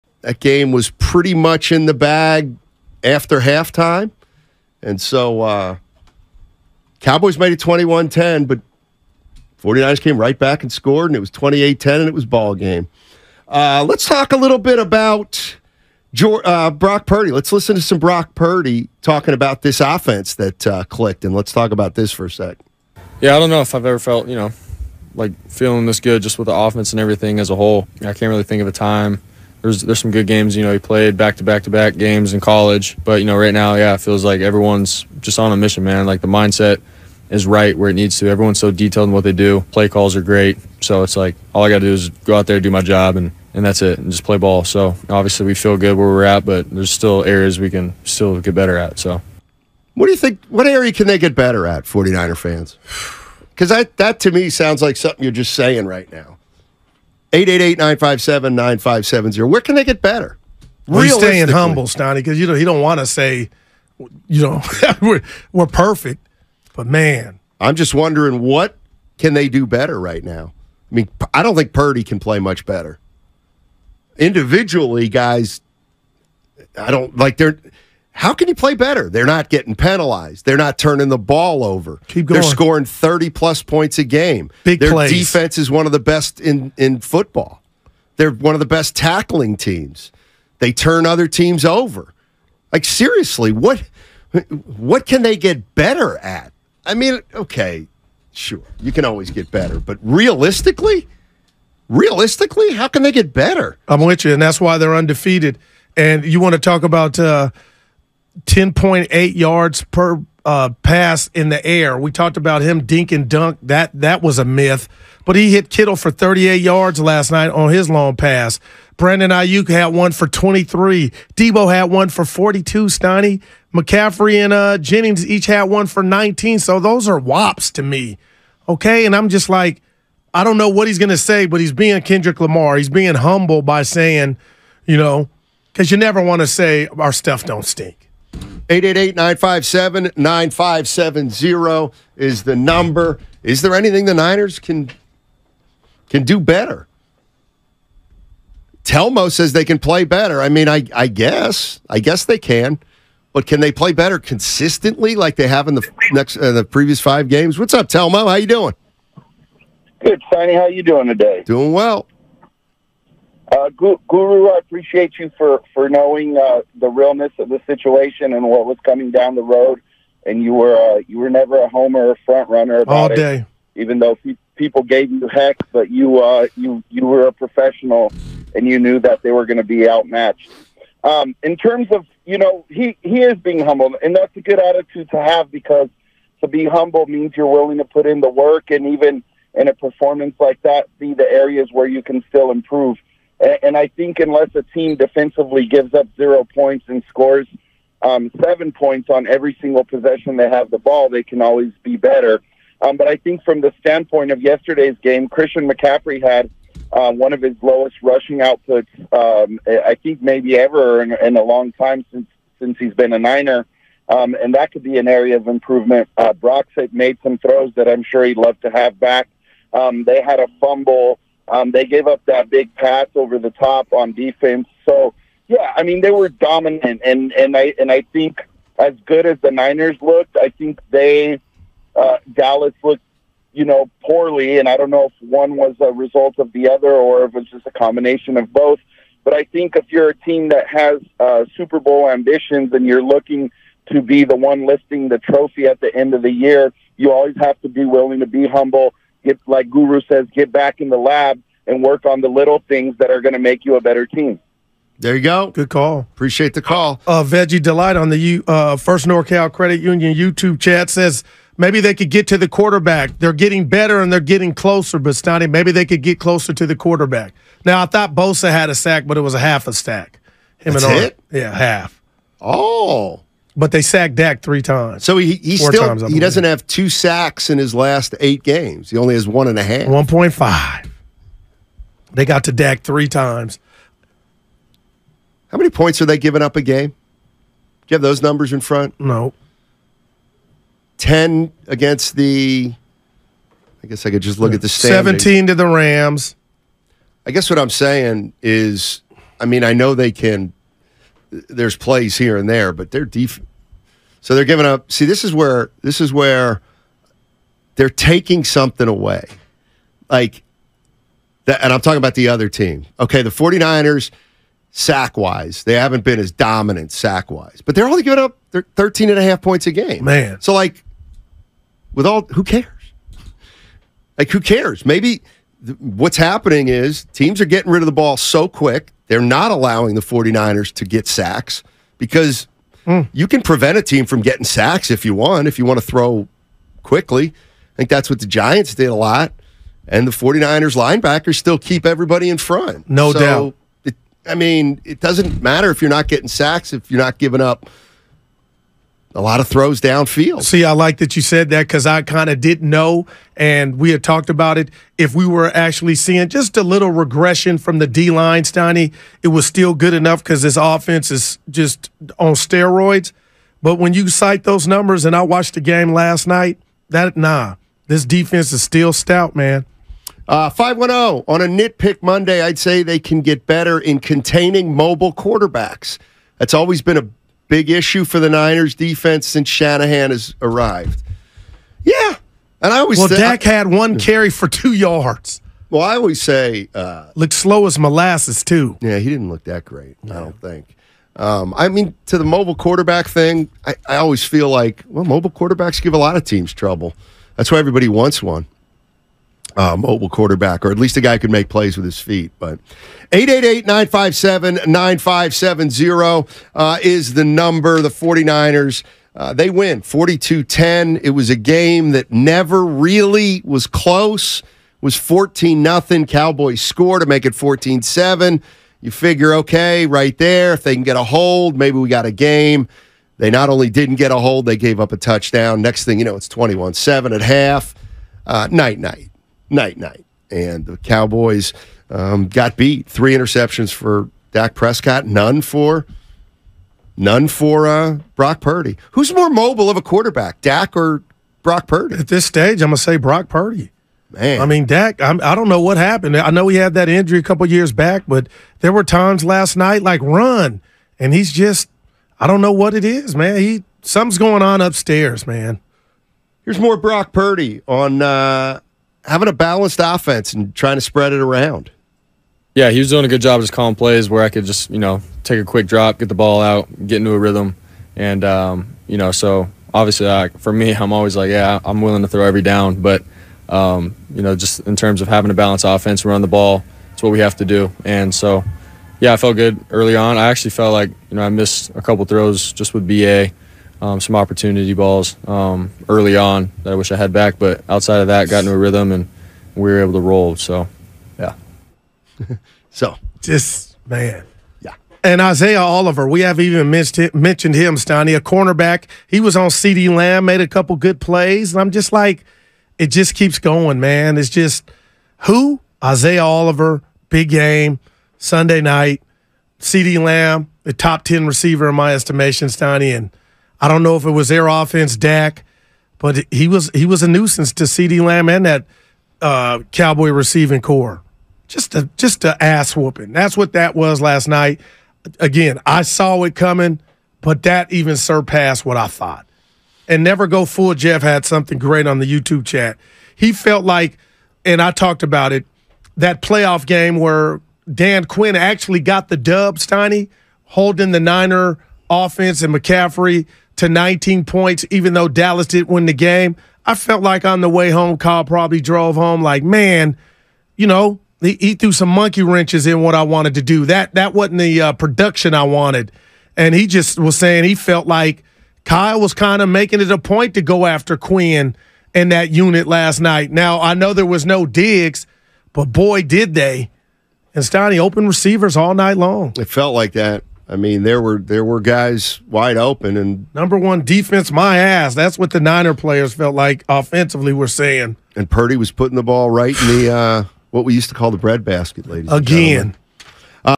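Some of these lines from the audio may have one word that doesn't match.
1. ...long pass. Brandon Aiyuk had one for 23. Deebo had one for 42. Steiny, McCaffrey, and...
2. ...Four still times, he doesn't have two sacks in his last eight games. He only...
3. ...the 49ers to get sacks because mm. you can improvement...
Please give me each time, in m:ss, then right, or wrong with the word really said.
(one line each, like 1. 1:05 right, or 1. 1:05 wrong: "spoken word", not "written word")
1. 1:57 right
2. 4:35 right
3. 5:29 wrong: "prevent", not "improvement".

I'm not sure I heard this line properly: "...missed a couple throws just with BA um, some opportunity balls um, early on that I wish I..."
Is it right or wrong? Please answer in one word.
right.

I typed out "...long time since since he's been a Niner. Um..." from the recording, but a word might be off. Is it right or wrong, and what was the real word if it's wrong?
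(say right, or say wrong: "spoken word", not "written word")
right.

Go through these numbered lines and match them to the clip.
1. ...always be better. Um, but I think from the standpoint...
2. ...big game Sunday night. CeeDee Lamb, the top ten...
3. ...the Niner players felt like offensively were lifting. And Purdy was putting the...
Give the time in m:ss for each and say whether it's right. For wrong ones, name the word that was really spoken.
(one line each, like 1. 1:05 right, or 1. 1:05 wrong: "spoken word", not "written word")
1. 3:21 right
2. 8:27 right
3. 9:35 wrong: "saying", not "lifting".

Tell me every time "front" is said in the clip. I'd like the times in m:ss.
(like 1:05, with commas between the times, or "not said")
2:52, 4:48, 5:42.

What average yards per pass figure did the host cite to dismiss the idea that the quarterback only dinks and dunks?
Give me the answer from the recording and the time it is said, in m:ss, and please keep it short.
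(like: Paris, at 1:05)
10.8, at 1:48.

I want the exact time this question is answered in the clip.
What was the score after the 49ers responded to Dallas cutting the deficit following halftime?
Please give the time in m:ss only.
0:11.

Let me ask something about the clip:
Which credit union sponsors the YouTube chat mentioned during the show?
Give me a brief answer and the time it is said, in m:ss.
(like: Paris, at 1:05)
First NorCal Credit Union, at 4:18.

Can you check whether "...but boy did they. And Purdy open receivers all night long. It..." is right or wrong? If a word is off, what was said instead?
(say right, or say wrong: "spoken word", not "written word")
wrong: "Stoney", not "Purdy".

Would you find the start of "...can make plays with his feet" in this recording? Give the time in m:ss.
6:41.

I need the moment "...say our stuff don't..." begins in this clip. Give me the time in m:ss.
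2:16.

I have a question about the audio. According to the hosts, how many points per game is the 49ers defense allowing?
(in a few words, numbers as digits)
13.5.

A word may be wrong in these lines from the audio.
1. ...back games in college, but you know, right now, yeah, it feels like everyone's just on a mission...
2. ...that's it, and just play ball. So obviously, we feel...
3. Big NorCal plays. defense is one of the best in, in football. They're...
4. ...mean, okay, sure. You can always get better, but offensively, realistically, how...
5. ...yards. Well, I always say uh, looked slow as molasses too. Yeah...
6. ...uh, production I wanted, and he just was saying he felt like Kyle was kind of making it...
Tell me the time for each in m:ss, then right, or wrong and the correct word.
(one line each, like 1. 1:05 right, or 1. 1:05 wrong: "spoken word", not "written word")
1. 0:31 right
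2. 0:43 right
3. 1:24 wrong: "Their", not "NorCal"
4. 1:36 wrong: "realistically", not "offensively"
5. 6:24 right
6. 9:14 right.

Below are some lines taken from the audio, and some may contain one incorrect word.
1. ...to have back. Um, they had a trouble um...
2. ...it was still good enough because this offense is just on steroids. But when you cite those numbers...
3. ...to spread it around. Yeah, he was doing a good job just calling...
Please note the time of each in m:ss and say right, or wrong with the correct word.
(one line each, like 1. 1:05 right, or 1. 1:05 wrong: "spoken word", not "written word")
1. 3:38 wrong: "fumble", not "trouble"
2. 5:59 right
3. 7:40 right.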